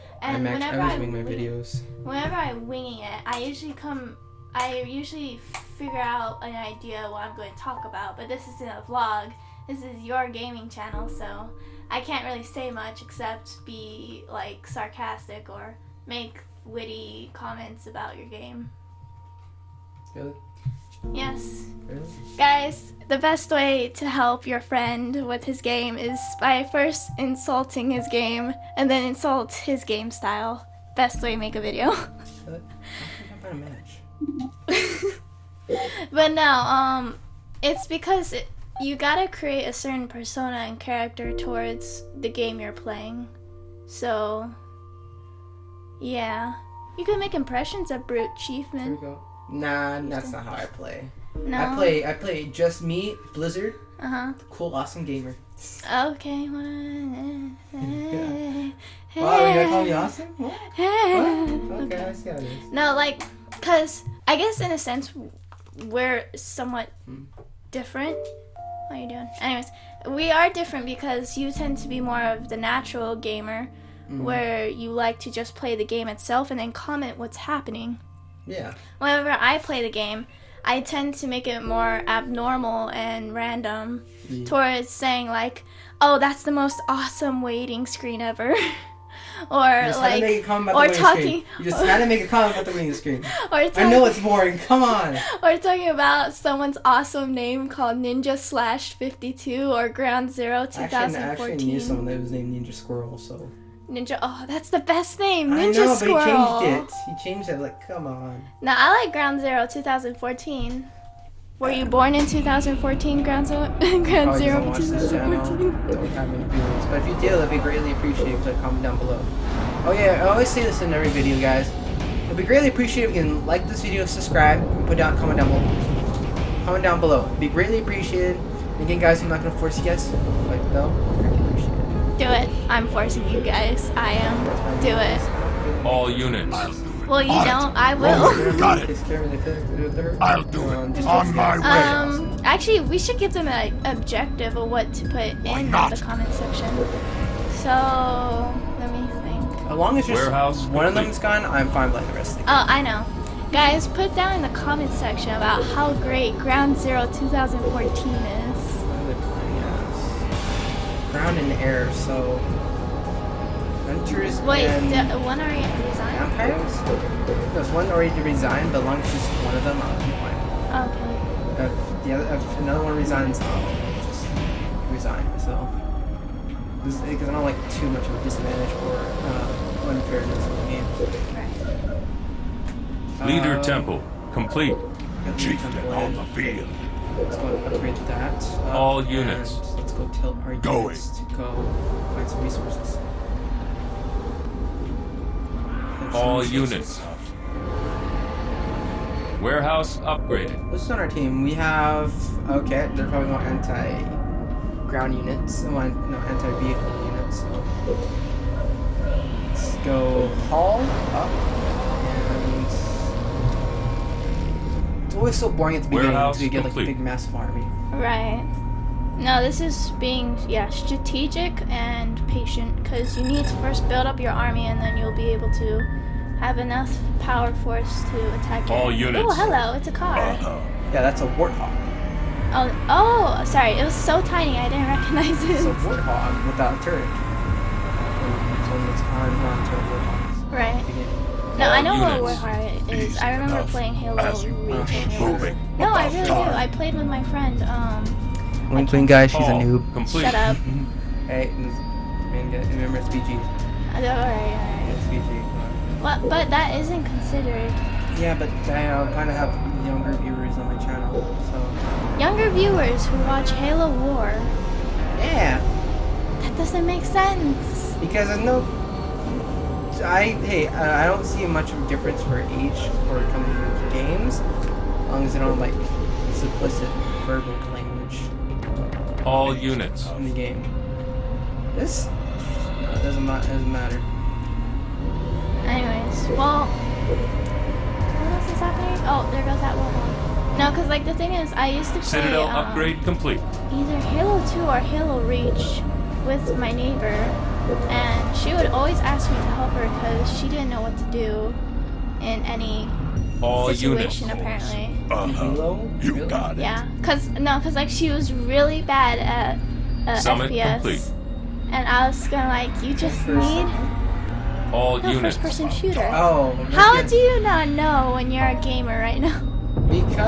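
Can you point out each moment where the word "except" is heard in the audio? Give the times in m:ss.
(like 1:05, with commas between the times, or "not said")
0:13.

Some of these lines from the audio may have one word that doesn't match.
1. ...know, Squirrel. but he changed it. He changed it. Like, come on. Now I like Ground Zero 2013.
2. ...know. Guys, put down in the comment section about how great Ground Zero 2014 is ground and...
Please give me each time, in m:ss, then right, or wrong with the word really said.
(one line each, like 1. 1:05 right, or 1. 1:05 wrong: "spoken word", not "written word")
1. 1:45 wrong: "2014", not "2013"
2. 2:32 right.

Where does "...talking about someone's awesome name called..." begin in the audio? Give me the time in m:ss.
1:35.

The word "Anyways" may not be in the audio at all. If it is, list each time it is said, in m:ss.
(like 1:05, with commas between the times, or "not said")
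1:09, 4:45.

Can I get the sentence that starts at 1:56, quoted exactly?
But if you do, it'd be greatly appreciated.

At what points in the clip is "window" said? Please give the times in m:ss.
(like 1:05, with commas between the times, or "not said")
not said.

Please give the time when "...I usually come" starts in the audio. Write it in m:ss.
0:03.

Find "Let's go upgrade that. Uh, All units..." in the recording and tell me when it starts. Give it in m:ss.
3:07.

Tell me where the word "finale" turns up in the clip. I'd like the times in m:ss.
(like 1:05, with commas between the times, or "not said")
not said.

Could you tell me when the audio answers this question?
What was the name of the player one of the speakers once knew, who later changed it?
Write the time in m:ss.
1:42.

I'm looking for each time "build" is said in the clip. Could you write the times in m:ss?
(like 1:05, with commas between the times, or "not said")
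3:43.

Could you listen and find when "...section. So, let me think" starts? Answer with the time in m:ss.
2:26.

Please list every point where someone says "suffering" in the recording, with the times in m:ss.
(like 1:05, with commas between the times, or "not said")
not said.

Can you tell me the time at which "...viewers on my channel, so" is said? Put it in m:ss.
4:20.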